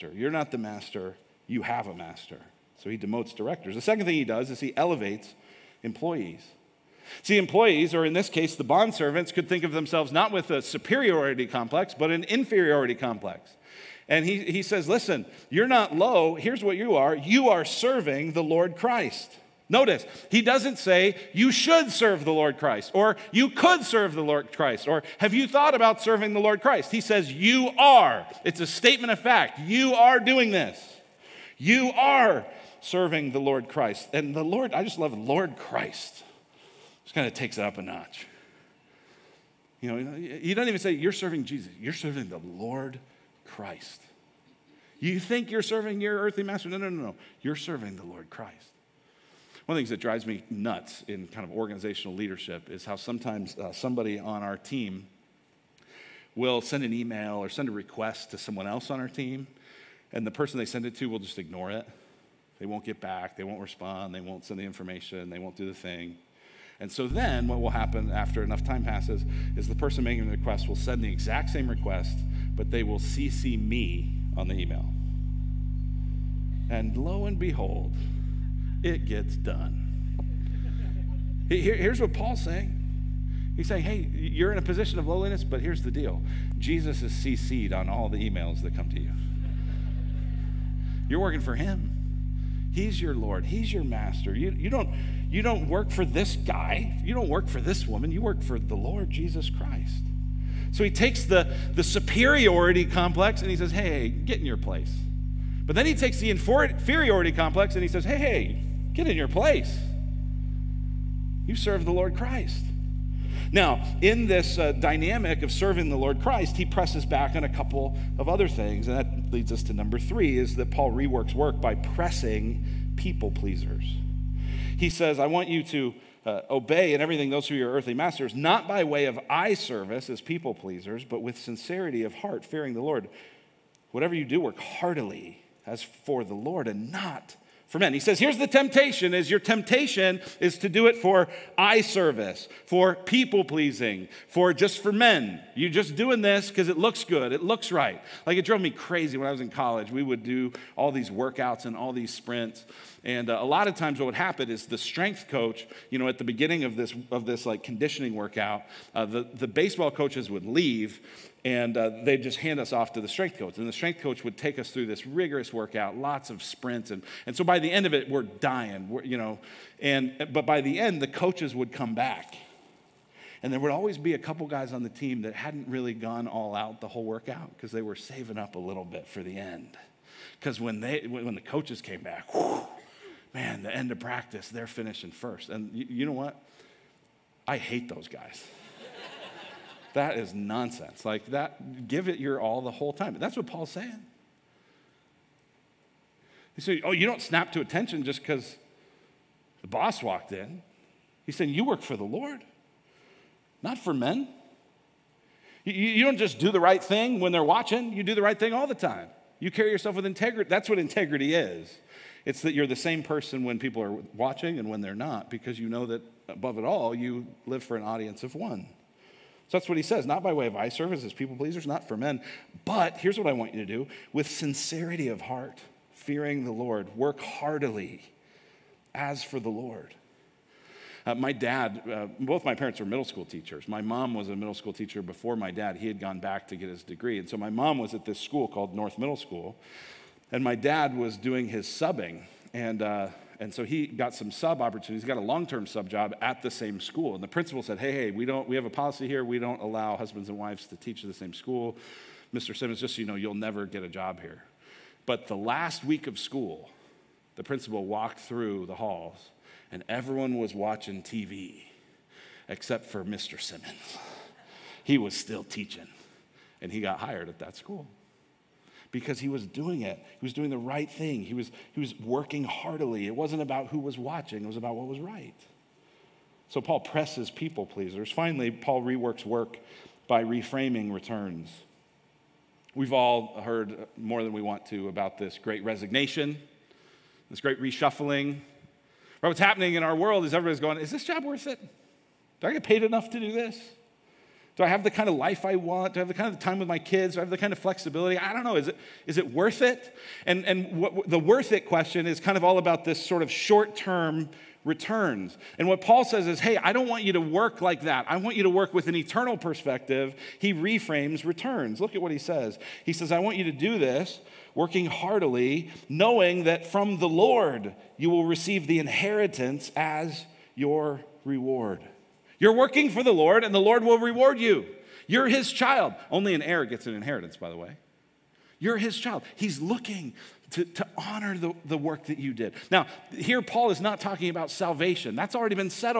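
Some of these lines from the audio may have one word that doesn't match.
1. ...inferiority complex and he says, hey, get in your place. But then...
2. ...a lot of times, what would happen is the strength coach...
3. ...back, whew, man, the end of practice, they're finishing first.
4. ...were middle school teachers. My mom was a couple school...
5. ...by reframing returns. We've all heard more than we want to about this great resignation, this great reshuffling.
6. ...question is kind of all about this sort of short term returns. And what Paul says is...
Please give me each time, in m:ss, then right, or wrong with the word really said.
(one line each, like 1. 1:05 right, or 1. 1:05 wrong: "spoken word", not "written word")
1. 1:41 wrong: "superiority", not "inferiority"
2. 2:33 right
3. 3:02 right
4. 3:52 wrong: "middle", not "couple"
5. 4:40 right
6. 5:01 right.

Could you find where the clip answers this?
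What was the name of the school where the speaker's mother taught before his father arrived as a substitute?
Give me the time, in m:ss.
3:58.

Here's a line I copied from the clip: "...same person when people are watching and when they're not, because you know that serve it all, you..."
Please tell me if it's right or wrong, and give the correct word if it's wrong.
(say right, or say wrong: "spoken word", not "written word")
wrong: "above", not "serve".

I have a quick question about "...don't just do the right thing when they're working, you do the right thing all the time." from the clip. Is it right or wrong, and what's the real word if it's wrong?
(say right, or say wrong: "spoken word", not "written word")
wrong: "watching", not "working".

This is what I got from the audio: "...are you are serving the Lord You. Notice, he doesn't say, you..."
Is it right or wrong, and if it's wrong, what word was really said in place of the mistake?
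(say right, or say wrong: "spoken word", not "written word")
wrong: "Christ", not "You".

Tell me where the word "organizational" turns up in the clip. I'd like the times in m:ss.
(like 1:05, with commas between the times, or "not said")
0:51.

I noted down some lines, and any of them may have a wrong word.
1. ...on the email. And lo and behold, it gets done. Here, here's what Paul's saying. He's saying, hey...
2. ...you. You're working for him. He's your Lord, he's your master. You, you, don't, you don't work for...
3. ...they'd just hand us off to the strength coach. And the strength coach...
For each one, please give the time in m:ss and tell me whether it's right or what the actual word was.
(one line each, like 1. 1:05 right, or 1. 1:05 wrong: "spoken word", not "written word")
1. 1:14 right
2. 1:28 right
3. 2:42 right.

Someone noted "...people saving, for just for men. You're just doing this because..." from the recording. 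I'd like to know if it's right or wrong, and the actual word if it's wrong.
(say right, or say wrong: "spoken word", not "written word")
wrong: "pleasing", not "saving".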